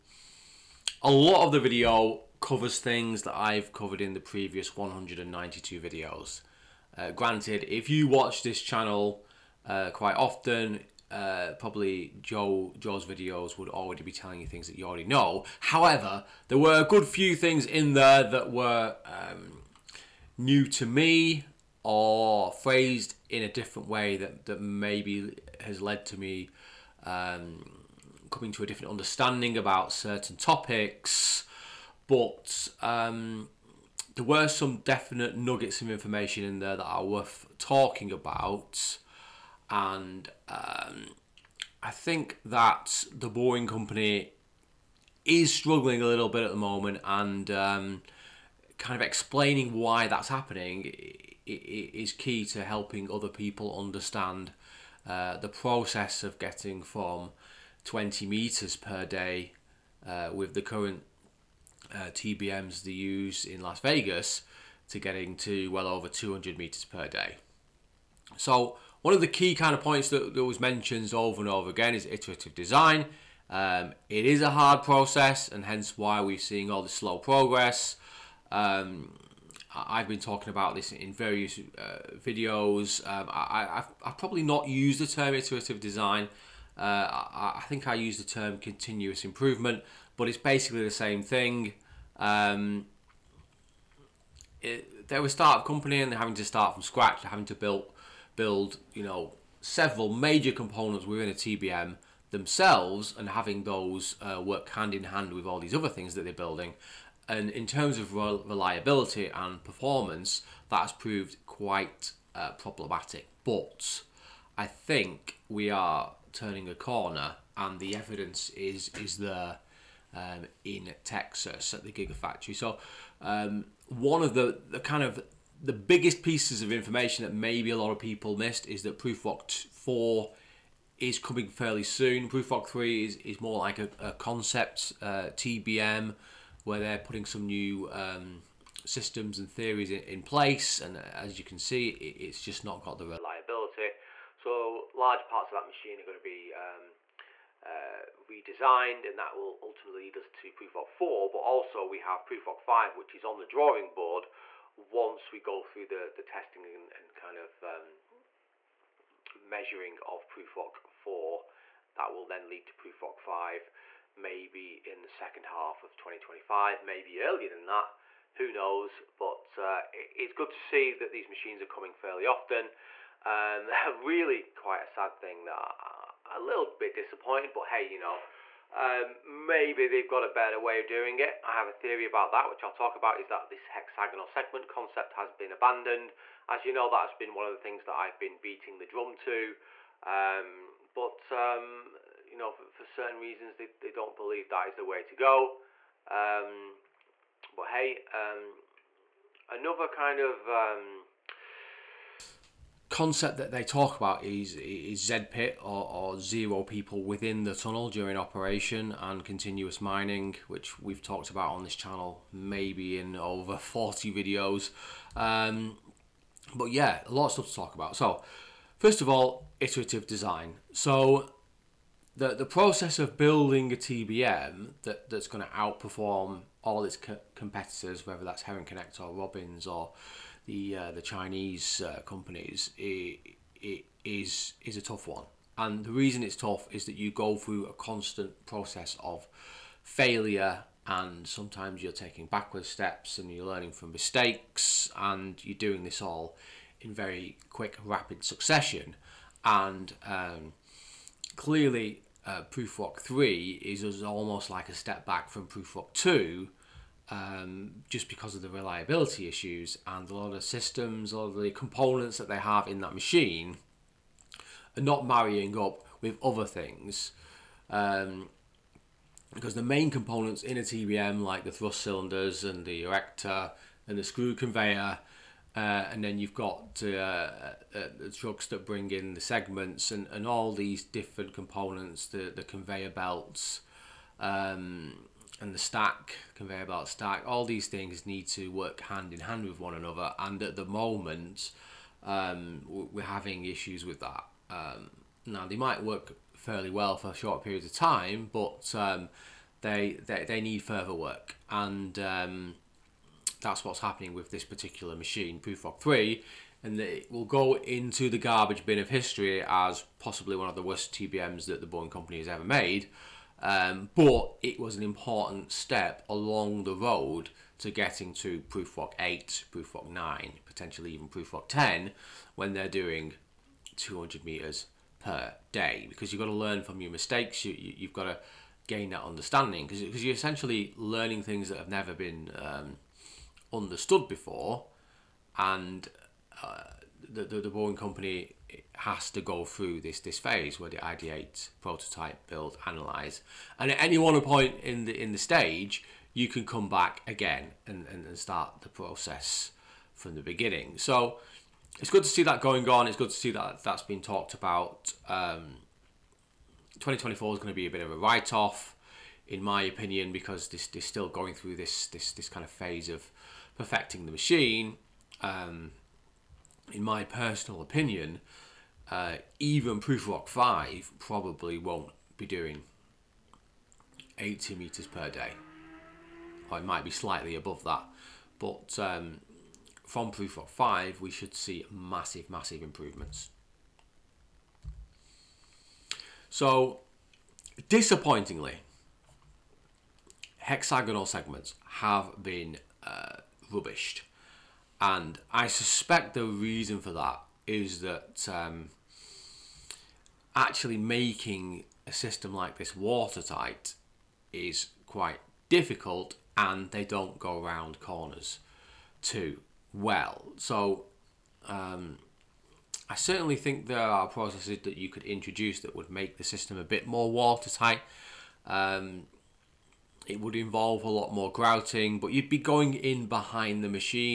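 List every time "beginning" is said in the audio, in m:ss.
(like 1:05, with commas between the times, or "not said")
5:50.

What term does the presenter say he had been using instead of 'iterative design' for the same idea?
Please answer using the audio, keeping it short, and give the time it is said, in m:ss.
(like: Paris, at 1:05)
continuous improvement, at 1:28.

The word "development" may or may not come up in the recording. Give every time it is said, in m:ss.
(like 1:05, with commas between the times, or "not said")
not said.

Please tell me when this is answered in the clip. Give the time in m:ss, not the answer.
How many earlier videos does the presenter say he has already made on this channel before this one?
0:04.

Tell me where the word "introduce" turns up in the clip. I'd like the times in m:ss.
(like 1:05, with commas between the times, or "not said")
6:55.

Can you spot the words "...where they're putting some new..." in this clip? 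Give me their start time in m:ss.
2:16.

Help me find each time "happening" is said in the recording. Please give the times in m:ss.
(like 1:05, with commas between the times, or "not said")
0:50, 5:03.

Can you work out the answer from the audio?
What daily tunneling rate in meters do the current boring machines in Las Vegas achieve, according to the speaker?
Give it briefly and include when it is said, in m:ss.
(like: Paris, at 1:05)
20 meters per day, at 0:57.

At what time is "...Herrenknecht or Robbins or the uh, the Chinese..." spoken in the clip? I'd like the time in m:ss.
3:48.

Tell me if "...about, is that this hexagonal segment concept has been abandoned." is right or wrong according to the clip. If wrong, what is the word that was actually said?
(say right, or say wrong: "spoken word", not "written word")
right.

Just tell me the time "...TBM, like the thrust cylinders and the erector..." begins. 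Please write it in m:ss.
4:30.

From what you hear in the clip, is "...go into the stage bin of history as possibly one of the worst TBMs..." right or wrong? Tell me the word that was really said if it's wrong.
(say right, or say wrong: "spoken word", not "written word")
wrong: "garbage", not "stage".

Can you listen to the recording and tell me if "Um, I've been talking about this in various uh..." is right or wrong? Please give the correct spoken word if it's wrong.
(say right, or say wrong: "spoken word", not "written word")
right.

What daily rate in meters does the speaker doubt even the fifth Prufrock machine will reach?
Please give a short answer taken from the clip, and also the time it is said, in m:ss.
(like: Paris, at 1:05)
80 meters per day, at 6:14.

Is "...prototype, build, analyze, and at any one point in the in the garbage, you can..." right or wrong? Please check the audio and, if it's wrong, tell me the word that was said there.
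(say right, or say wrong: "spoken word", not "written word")
wrong: "stage", not "garbage".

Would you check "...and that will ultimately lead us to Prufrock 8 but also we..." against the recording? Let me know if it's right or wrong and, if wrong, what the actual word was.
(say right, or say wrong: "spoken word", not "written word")
wrong: "4", not "8".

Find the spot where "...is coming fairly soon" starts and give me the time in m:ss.
2:10.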